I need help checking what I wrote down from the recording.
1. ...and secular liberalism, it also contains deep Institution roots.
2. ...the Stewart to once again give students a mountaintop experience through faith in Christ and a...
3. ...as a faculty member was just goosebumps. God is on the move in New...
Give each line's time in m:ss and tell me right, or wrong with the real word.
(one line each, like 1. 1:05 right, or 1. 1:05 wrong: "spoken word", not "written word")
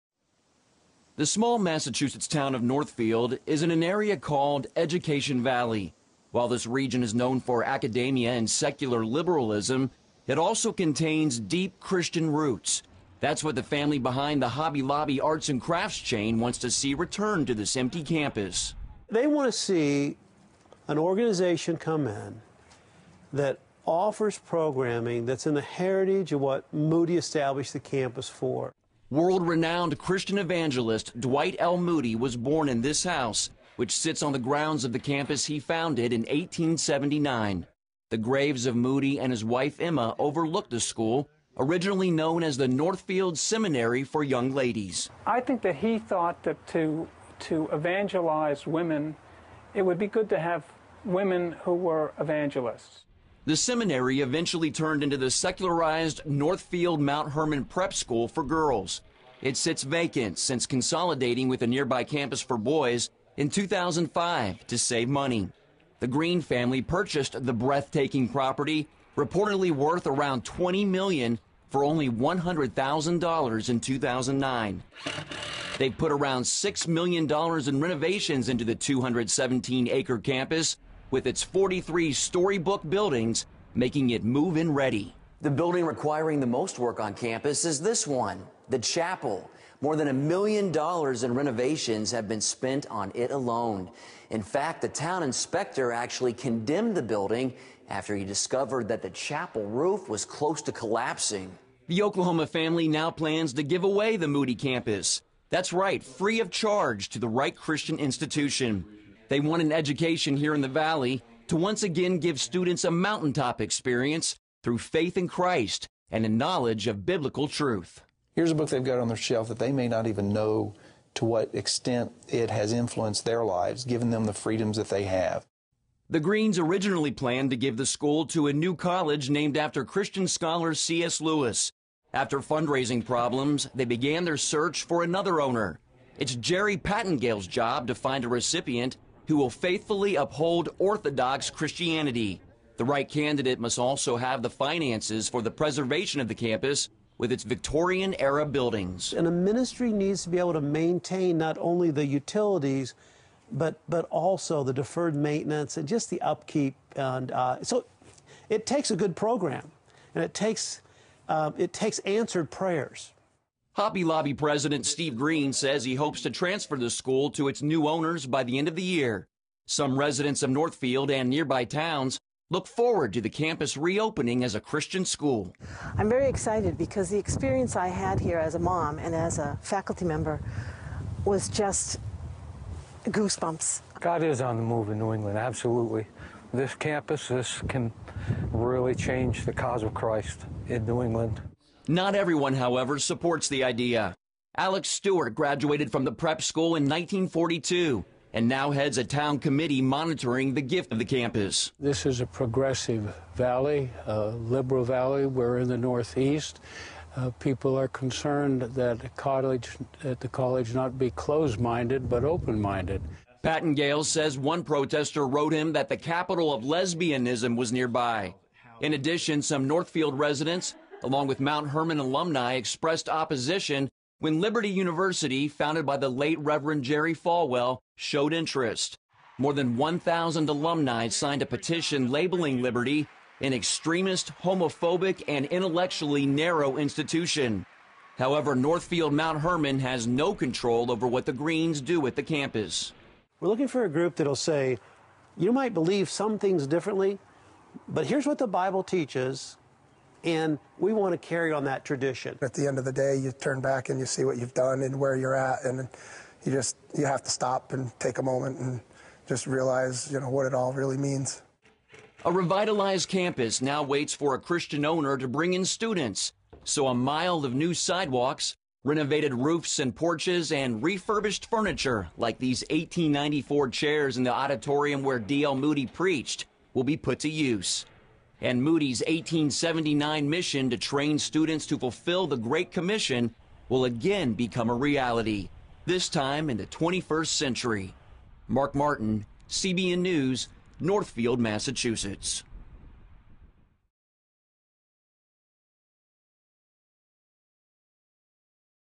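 1. 0:08 wrong: "Christian", not "Institution"
2. 1:50 wrong: "Valley", not "Stewart"
3. 2:59 right.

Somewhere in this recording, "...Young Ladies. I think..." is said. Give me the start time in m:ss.
0:44.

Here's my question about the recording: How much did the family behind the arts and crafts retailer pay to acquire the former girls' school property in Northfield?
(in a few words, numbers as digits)
$100,000.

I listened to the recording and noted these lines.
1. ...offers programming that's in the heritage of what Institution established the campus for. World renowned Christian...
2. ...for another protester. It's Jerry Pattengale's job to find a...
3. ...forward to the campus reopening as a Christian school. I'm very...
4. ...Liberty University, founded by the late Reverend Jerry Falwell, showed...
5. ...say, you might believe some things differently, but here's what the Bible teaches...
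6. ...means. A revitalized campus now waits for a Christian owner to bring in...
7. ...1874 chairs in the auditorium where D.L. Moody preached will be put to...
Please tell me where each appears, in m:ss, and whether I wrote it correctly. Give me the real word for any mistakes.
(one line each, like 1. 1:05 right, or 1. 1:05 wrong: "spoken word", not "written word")
1. 0:23 wrong: "Moody", not "Institution"
2. 2:14 wrong: "owner", not "protester"
3. 2:52 right
4. 3:44 right
5. 4:04 right
6. 4:20 right
7. 4:32 wrong: "1894", not "1874".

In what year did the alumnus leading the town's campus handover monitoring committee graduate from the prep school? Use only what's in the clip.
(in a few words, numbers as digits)
1942.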